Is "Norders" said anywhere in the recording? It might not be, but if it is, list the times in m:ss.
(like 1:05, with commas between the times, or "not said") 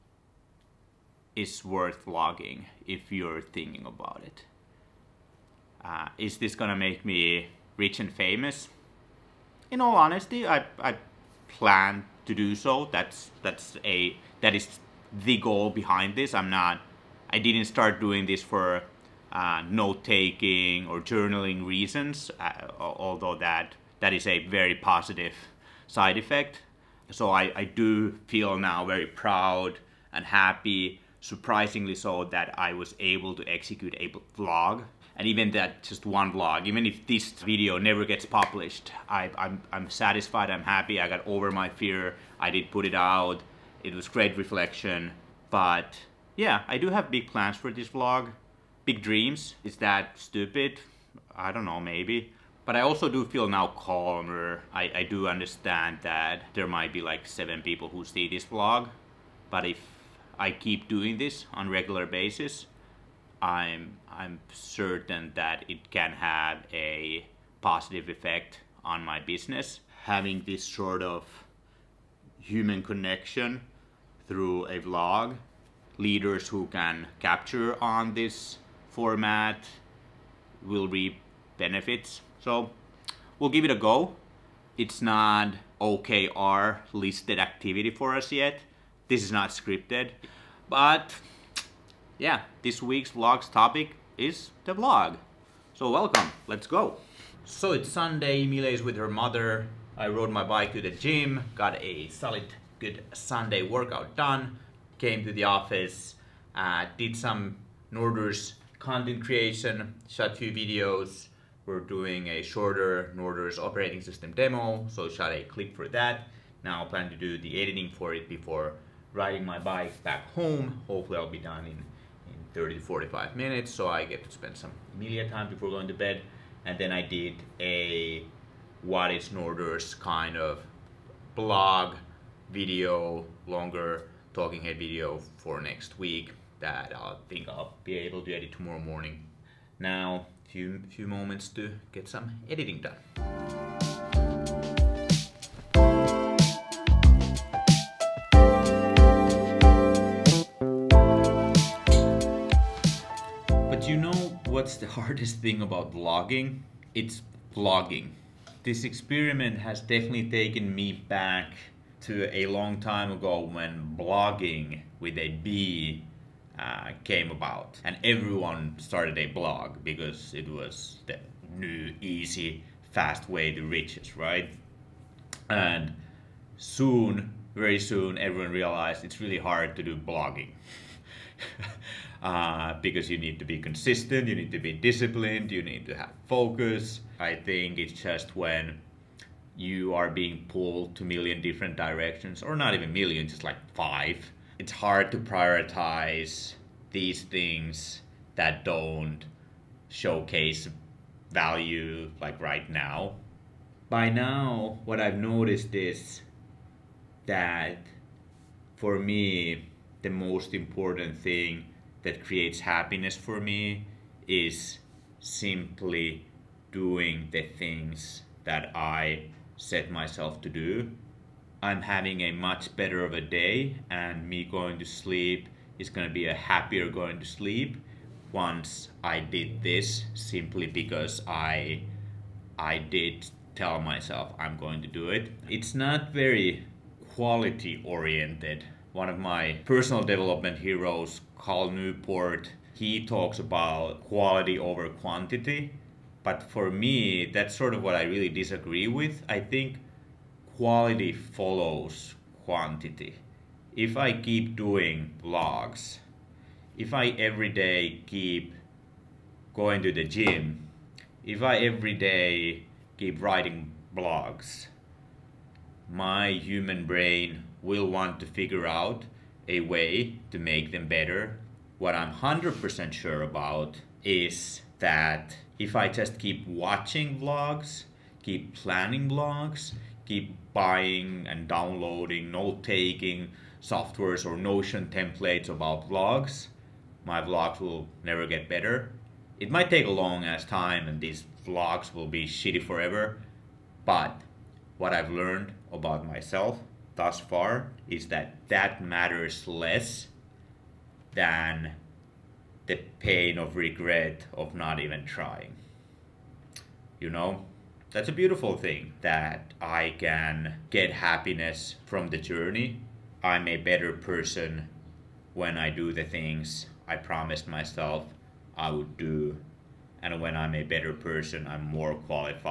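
1:47, 1:53, 2:09.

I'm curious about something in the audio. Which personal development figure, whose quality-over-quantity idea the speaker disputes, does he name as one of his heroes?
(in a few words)
Cal Newport.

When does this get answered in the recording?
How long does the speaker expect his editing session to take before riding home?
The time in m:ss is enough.
2:02.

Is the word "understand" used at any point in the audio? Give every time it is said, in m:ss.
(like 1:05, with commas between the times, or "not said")
0:55.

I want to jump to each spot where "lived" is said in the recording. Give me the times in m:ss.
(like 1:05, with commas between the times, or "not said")
not said.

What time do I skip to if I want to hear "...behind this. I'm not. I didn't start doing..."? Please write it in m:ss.
0:15.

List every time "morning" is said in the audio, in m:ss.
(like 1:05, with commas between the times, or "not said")
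2:18.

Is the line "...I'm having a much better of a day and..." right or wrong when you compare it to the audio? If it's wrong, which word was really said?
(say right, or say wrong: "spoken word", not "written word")
right.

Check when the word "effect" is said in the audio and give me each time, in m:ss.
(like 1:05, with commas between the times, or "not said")
0:26, 1:08.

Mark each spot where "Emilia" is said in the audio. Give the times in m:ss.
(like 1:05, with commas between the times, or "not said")
1:38, 2:04.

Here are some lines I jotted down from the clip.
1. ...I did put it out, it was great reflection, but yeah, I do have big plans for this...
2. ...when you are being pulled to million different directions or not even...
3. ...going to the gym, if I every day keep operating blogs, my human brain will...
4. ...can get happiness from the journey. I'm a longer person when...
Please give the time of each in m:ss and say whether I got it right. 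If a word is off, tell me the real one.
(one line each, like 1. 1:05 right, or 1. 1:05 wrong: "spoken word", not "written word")
1. 0:42 right
2. 3:08 right
3. 4:19 wrong: "writing", not "operating"
4. 5:09 wrong: "better", not "longer".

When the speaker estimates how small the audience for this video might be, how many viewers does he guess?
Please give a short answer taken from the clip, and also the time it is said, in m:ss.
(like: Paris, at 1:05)
7, at 0:57.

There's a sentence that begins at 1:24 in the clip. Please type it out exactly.
It's not OKR listed activity for us yet.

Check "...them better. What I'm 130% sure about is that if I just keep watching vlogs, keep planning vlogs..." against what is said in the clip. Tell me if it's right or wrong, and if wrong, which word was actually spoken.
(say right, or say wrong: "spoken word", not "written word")
wrong: "100", not "130".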